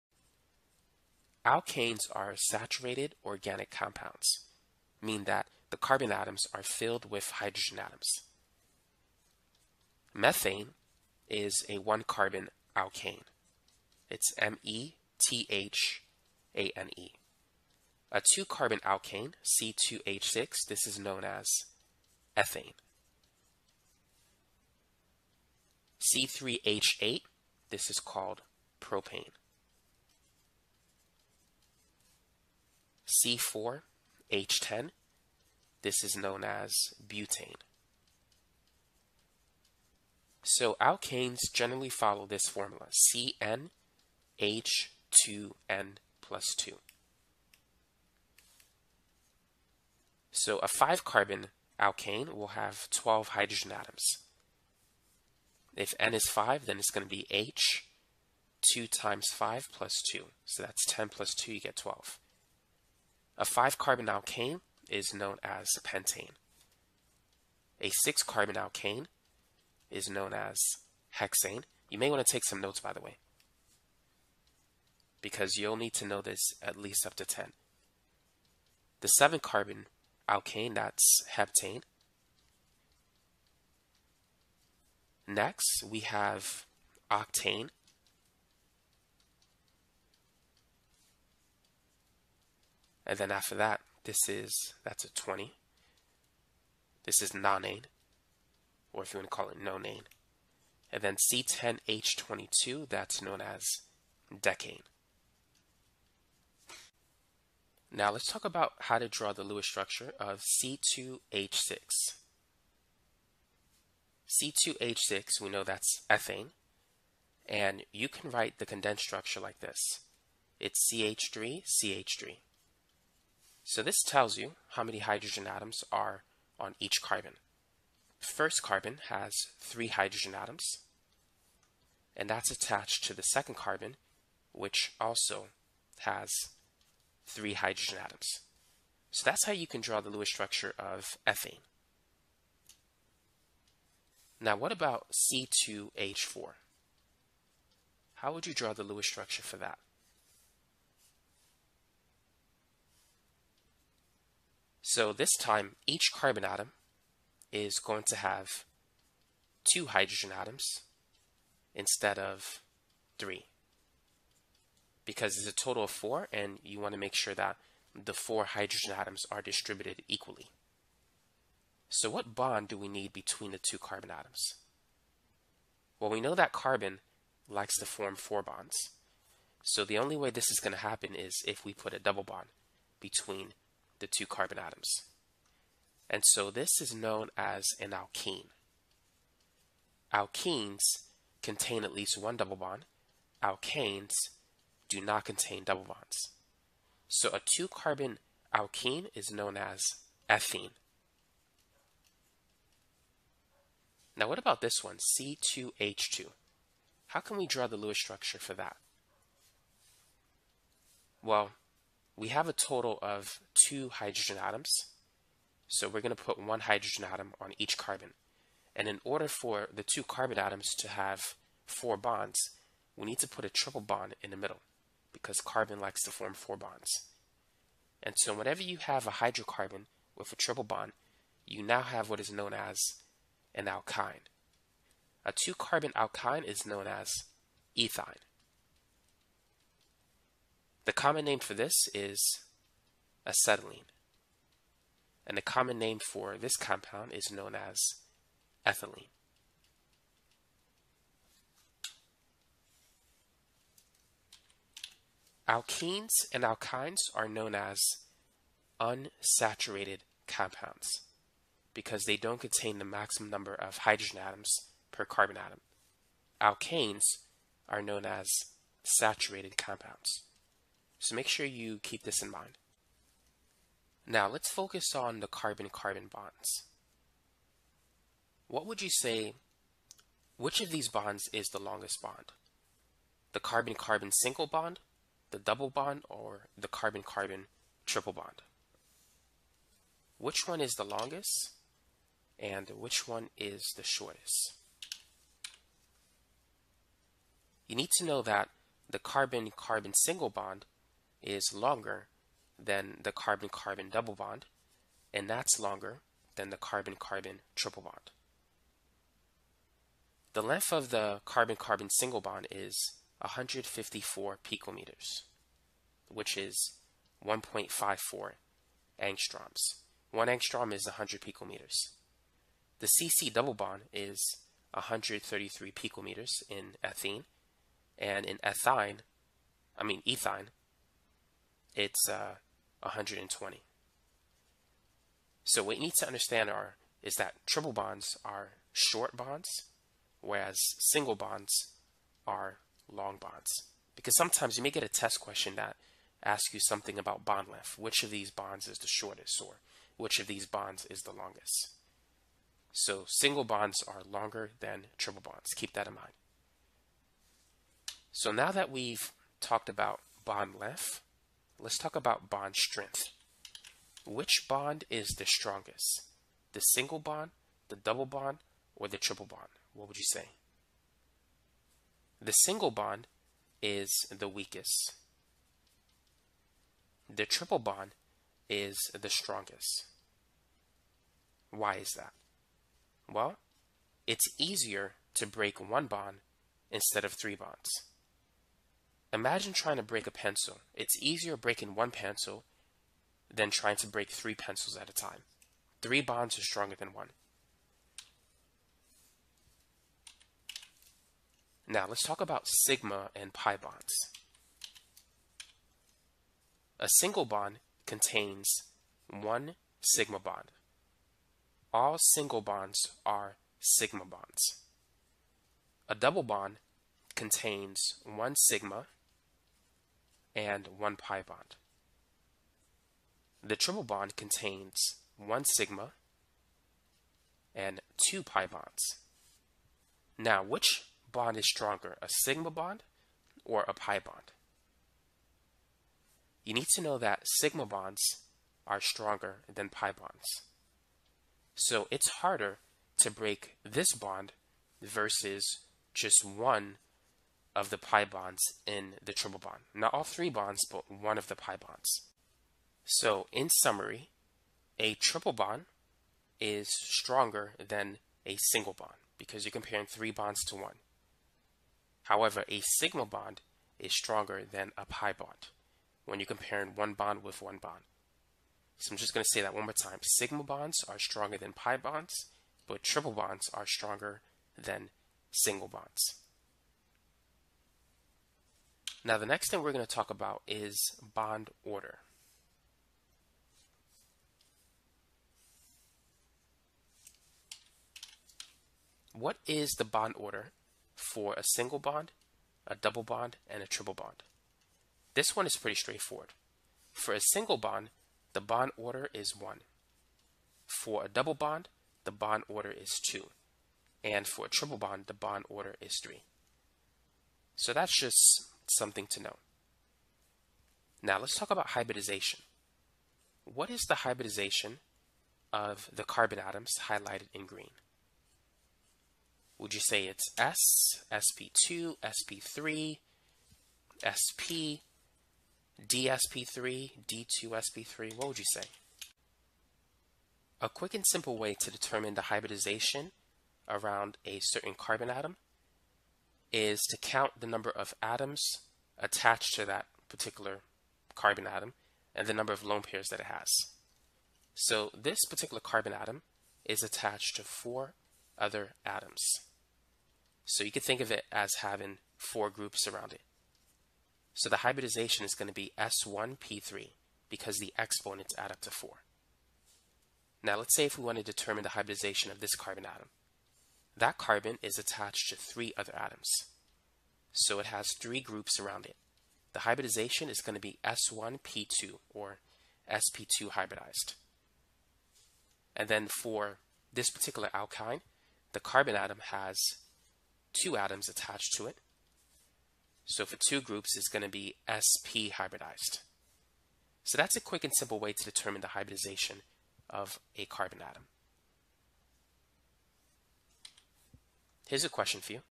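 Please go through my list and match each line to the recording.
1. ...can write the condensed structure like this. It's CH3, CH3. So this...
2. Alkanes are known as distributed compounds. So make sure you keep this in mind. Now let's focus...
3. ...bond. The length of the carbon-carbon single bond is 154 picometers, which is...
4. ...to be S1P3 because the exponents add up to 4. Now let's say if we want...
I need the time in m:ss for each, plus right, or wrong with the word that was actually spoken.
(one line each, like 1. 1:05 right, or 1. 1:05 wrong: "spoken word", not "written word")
1. 1:58 right
2. 4:26 wrong: "saturated", not "distributed"
3. 5:07 right
4. 9:15 right.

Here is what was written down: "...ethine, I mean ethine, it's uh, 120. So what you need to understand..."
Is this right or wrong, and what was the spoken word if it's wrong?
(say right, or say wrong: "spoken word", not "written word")
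right.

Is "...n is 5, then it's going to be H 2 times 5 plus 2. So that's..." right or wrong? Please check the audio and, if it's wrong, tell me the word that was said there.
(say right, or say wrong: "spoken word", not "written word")
right.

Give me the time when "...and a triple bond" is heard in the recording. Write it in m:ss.
8:13.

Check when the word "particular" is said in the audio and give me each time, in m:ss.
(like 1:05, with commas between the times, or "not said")
9:00, 9:05, 9:37.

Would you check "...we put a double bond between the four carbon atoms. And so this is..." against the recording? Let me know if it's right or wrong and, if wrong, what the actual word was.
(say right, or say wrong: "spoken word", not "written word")
wrong: "two", not "four".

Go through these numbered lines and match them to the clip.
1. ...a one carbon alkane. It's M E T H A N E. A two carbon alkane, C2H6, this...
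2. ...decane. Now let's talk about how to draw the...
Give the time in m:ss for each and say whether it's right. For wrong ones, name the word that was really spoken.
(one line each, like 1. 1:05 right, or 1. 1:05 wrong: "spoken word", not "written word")
1. 0:11 right
2. 1:44 right.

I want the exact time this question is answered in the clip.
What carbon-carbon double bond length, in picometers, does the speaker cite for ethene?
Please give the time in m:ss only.
5:24.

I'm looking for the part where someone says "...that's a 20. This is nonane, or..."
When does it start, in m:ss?
1:34.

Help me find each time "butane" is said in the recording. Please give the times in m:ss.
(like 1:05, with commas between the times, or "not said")
0:37.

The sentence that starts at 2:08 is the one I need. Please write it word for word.
First carbon has three hydrogen atoms, and that's attached to the second carbon, which also has three hydrogen atoms.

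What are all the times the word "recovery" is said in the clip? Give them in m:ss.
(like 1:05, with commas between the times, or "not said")
not said.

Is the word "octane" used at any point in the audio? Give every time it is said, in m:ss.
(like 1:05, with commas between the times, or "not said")
1:27.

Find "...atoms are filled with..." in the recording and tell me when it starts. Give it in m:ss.
0:06.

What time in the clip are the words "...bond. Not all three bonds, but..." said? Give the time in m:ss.
7:29.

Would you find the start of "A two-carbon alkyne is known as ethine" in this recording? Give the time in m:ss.
3:55.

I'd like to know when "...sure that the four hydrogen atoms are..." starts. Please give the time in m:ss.
2:47.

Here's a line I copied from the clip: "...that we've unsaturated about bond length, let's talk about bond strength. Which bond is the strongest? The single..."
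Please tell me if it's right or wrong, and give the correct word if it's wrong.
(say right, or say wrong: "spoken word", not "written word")
wrong: "talked", not "unsaturated".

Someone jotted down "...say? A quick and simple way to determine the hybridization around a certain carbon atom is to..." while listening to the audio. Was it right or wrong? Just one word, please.
right.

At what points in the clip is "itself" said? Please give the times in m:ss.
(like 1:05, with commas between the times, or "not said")
not said.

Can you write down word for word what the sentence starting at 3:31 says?
Well, we have a total of two hydrogen atoms.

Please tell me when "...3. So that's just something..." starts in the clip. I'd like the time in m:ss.
8:26.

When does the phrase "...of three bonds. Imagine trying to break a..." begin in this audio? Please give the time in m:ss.
6:27.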